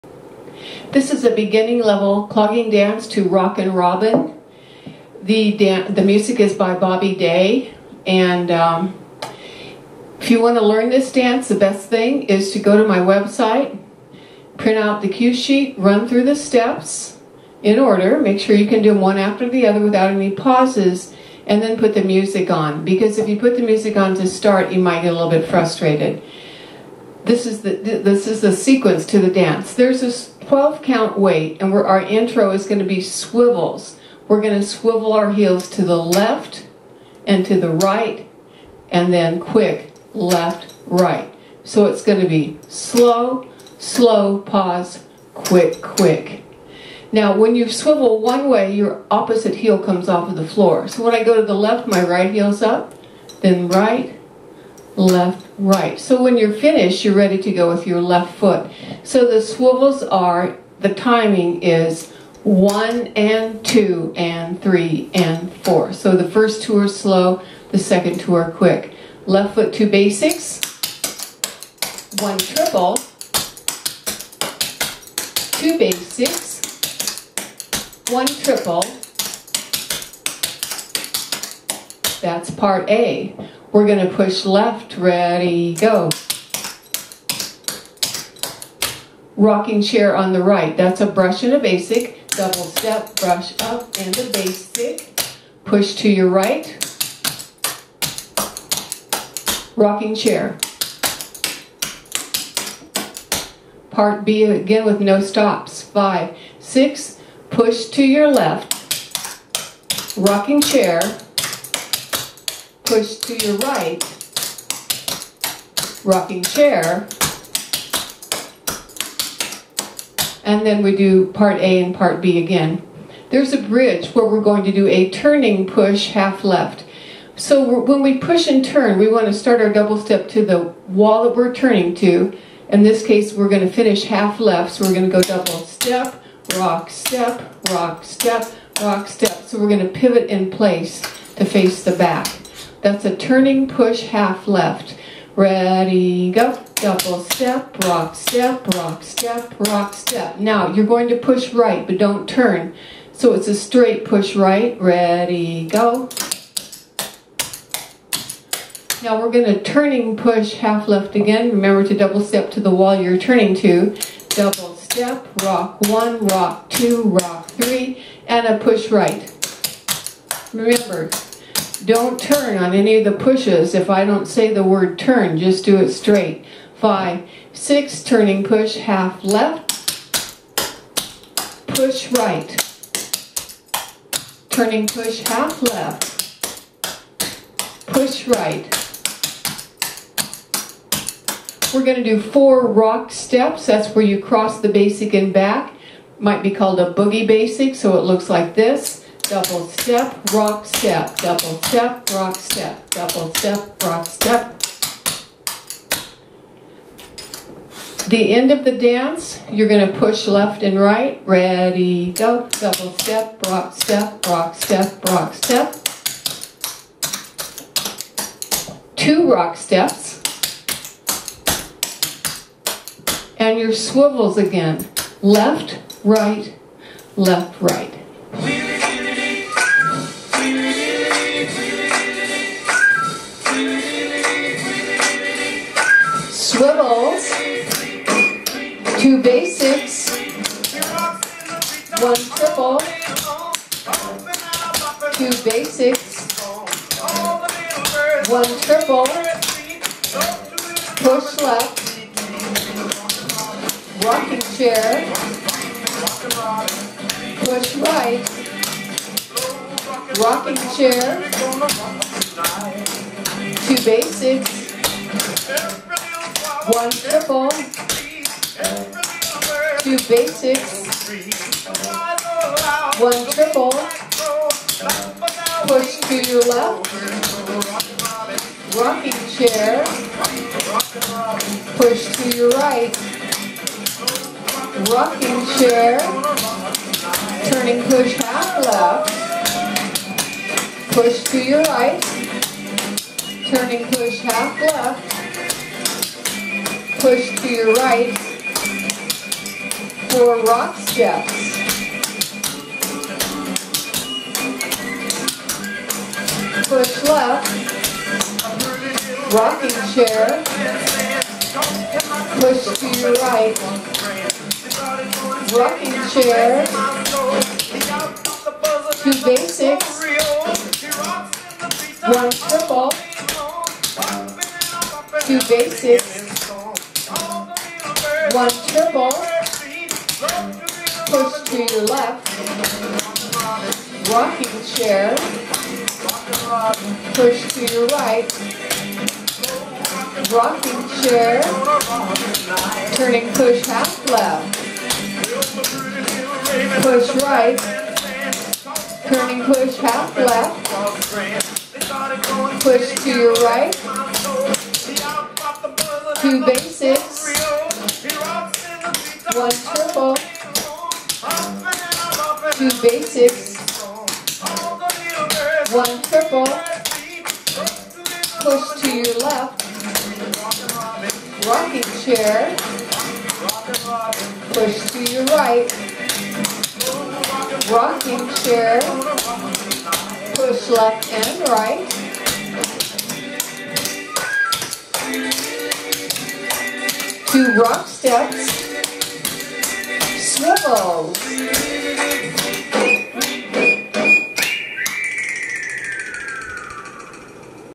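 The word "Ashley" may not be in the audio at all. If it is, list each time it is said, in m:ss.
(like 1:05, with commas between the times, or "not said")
not said.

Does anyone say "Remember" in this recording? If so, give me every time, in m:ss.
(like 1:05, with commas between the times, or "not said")
2:41, 2:50.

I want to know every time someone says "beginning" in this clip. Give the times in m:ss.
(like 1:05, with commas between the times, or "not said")
0:01.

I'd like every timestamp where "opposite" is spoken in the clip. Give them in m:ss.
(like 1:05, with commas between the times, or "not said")
0:49.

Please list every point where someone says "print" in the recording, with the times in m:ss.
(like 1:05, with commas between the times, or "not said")
0:14.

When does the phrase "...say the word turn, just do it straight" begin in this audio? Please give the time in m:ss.
2:54.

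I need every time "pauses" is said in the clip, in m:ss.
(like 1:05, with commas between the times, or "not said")
0:20, 0:44.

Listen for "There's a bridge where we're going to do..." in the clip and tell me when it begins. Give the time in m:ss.
2:03.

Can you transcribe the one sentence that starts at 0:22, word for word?
Because if you put the music on to start, you might get a little bit frustrated.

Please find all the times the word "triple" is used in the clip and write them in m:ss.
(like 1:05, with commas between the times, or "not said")
1:12, 1:18, 4:02, 4:08, 4:26, 4:33, 5:28, 6:06.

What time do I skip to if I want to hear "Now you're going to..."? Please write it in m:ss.
2:30.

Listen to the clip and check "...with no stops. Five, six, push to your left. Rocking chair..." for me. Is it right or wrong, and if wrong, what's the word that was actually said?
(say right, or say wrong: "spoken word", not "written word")
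right.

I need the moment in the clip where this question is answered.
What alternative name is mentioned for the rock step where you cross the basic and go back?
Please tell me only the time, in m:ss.
3:16.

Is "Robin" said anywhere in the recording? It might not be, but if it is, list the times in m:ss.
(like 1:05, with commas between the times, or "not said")
0:03.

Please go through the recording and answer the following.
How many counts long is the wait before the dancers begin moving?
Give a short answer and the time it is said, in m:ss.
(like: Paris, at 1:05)
12, at 0:30.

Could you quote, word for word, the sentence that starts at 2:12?
In this case, we're going to finish half left, so we're going to go double step, rock, step, rock, step, rock, step.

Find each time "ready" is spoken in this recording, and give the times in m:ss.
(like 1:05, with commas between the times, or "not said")
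0:57, 1:24, 2:25, 2:34, 3:31.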